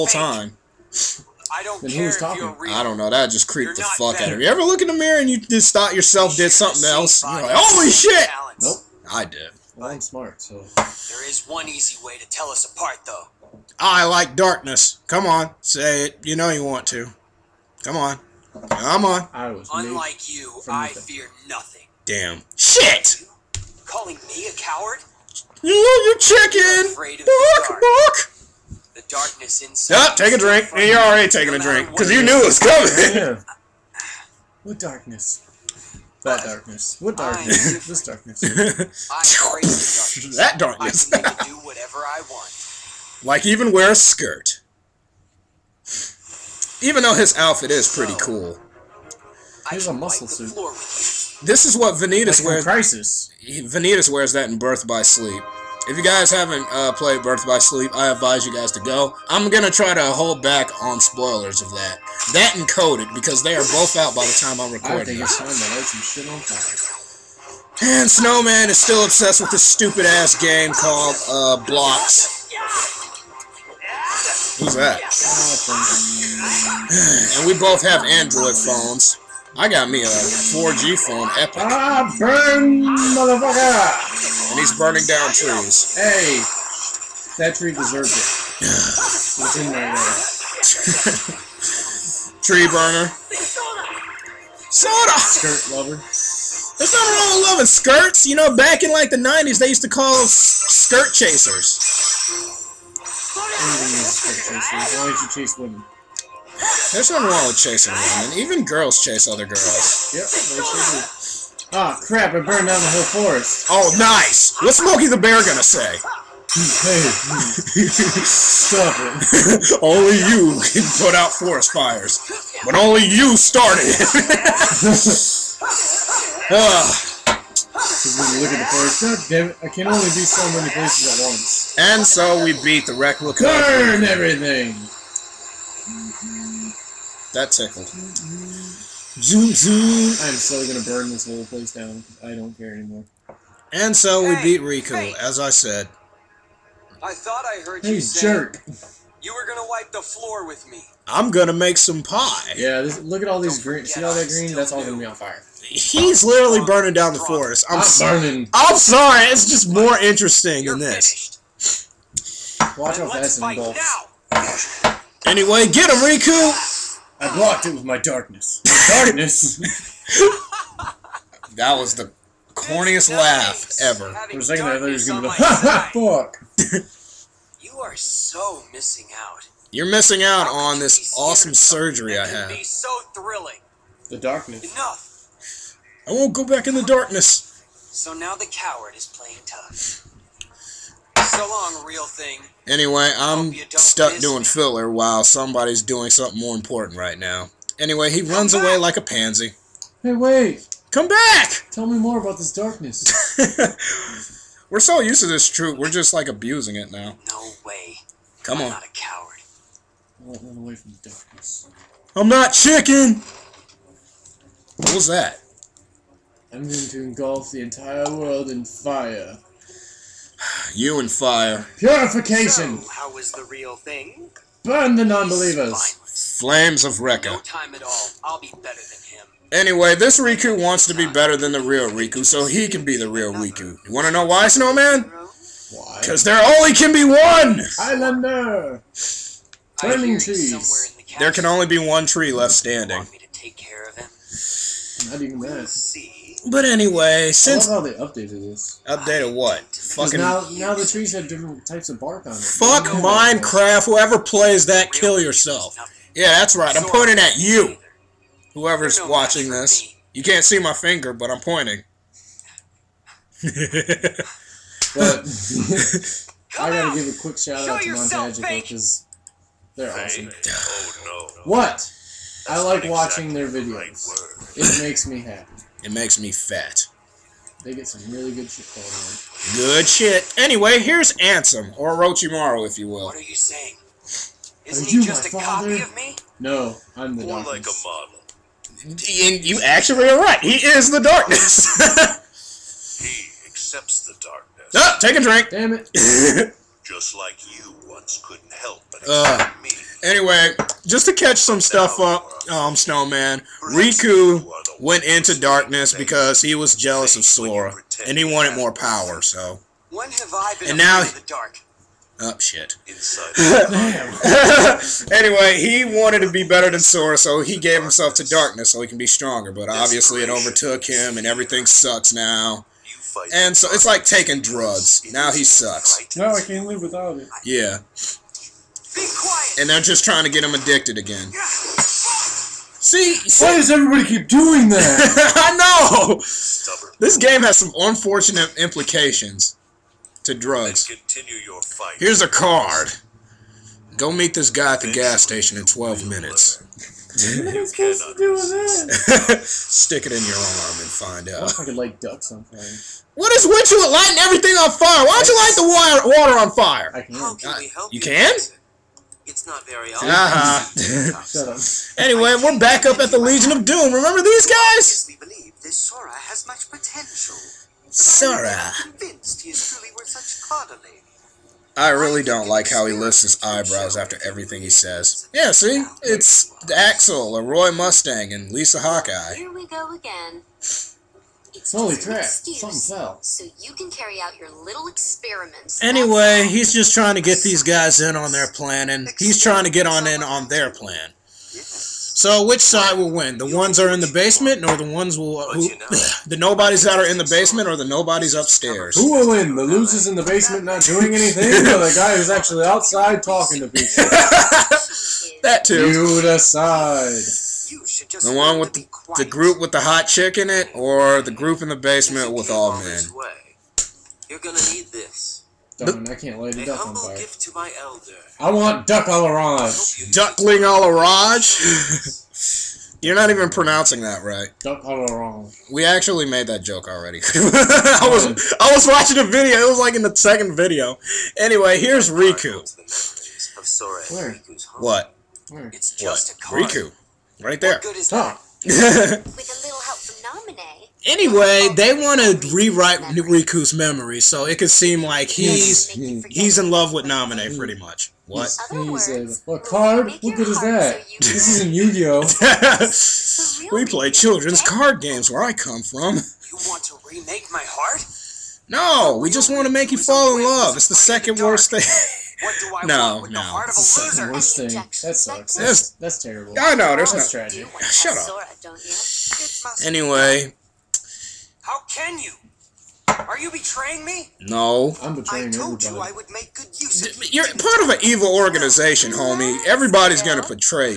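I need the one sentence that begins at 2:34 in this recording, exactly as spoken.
That's all gonna be on fire.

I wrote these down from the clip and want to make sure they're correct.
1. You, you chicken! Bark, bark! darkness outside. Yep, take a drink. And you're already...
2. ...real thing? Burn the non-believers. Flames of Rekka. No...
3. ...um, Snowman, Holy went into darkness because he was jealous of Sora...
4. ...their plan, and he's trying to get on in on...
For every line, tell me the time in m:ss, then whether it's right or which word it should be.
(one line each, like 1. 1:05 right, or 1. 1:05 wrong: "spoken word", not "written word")
1. 0:25 wrong: "inside", not "outside"
2. 3:43 right
3. 5:02 wrong: "Riku", not "Holy"
4. 6:28 right.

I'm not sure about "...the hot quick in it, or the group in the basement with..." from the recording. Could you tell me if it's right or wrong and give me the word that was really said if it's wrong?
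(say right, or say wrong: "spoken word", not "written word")
wrong: "chick", not "quick".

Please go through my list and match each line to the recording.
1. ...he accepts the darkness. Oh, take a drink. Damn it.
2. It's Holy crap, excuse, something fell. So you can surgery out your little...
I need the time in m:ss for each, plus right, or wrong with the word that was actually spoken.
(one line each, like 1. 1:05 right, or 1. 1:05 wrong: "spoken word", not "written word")
1. 4:52 right
2. 6:21 wrong: "carry", not "surgery".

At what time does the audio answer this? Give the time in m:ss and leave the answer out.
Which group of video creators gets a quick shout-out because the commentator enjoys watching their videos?
4:27.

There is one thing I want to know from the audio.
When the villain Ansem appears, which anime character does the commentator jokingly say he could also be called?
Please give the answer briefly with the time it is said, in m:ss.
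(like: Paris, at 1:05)
Orochimaru, at 4:41.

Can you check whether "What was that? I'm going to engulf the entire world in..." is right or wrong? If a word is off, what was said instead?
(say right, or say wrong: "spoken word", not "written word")
right.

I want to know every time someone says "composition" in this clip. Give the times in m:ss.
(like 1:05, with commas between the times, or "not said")
not said.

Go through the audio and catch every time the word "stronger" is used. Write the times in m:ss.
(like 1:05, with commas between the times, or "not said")
5:19.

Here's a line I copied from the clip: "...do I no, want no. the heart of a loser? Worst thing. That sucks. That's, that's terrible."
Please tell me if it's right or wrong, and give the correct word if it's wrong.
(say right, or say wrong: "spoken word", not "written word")
right.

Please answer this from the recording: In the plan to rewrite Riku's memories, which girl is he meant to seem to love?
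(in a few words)
Naminé.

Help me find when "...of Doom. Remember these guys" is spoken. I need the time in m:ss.
6:03.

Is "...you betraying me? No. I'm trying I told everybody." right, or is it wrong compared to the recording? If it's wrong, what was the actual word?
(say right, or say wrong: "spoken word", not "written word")
wrong: "betraying", not "trying".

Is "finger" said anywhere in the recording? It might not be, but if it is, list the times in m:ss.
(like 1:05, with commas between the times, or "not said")
4:20.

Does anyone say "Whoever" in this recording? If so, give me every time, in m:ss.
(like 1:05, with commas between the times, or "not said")
4:13, 4:18.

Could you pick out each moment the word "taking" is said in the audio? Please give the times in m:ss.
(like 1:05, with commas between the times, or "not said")
0:31, 5:24.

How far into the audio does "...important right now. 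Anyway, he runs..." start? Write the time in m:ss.
3:16.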